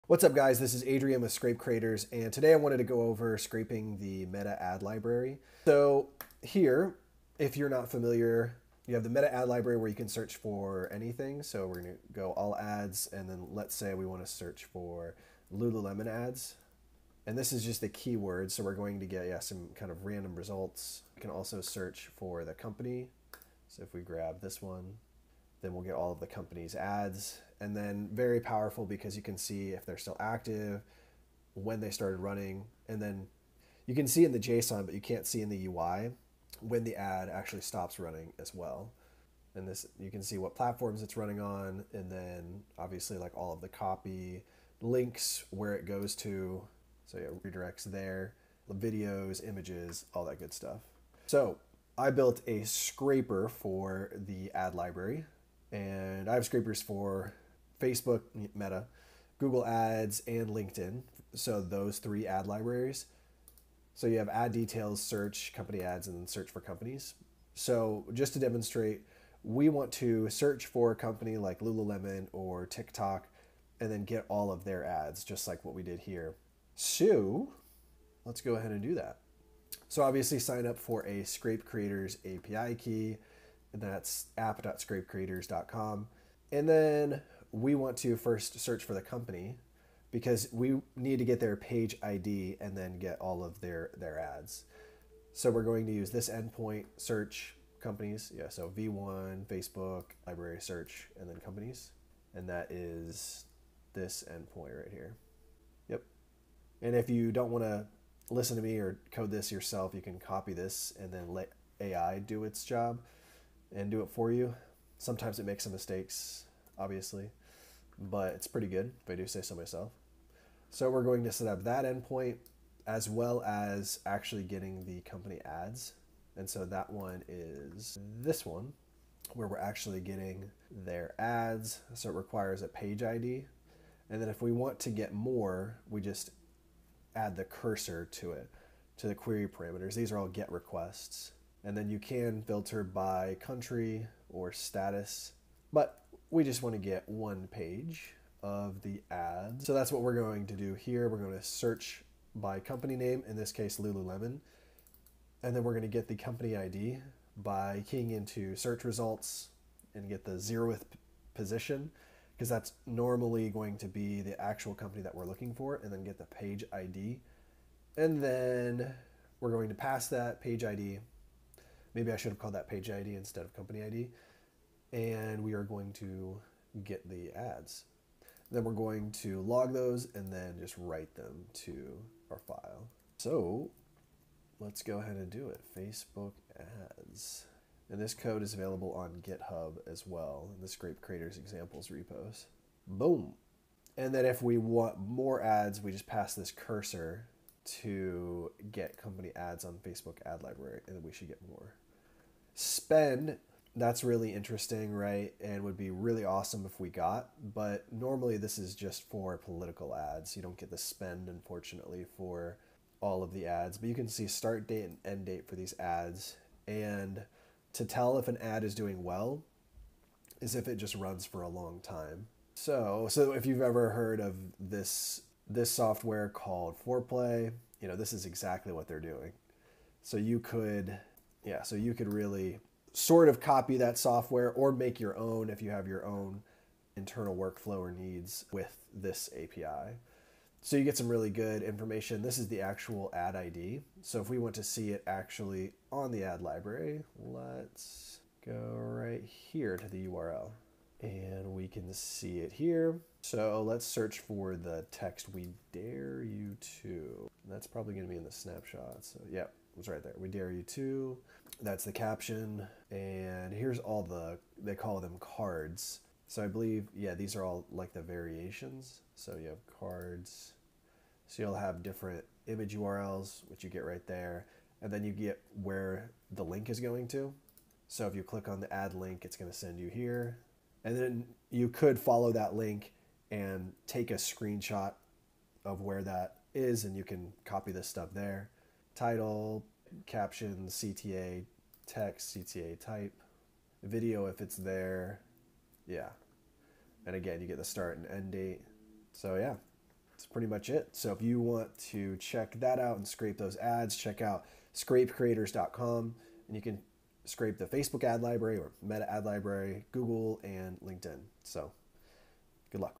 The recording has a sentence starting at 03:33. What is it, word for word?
But you can see start date and end date for these ads.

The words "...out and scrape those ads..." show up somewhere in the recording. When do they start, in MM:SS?
05:02.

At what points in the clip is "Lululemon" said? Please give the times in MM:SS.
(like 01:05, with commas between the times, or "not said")
00:15, 01:11, 02:33.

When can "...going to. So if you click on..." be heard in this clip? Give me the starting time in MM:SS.
04:36.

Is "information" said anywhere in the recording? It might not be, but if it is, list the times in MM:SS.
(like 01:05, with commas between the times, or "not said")
04:01.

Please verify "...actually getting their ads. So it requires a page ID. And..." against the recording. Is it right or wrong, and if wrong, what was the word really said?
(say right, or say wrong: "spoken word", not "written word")
right.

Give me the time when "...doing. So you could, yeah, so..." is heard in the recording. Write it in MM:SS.
03:48.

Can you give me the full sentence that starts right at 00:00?
This is Adrian with Scrape Creators, and today I wanted to go over scraping the meta ad library.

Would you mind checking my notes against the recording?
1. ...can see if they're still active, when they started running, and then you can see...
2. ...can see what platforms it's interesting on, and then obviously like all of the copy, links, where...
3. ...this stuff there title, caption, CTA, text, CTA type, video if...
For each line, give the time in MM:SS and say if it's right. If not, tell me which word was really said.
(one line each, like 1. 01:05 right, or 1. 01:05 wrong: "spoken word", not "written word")
1. 00:29 right
2. 00:40 wrong: "running", not "interesting"
3. 04:47 right.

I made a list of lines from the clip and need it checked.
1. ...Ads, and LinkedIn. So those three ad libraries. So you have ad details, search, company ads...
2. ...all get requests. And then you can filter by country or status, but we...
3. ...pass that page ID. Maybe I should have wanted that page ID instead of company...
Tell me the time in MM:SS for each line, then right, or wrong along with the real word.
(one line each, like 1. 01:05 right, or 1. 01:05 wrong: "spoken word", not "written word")
1. 00:59 right
2. 02:20 right
3. 02:49 wrong: "called", not "wanted".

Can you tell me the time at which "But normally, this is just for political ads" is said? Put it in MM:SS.
03:27.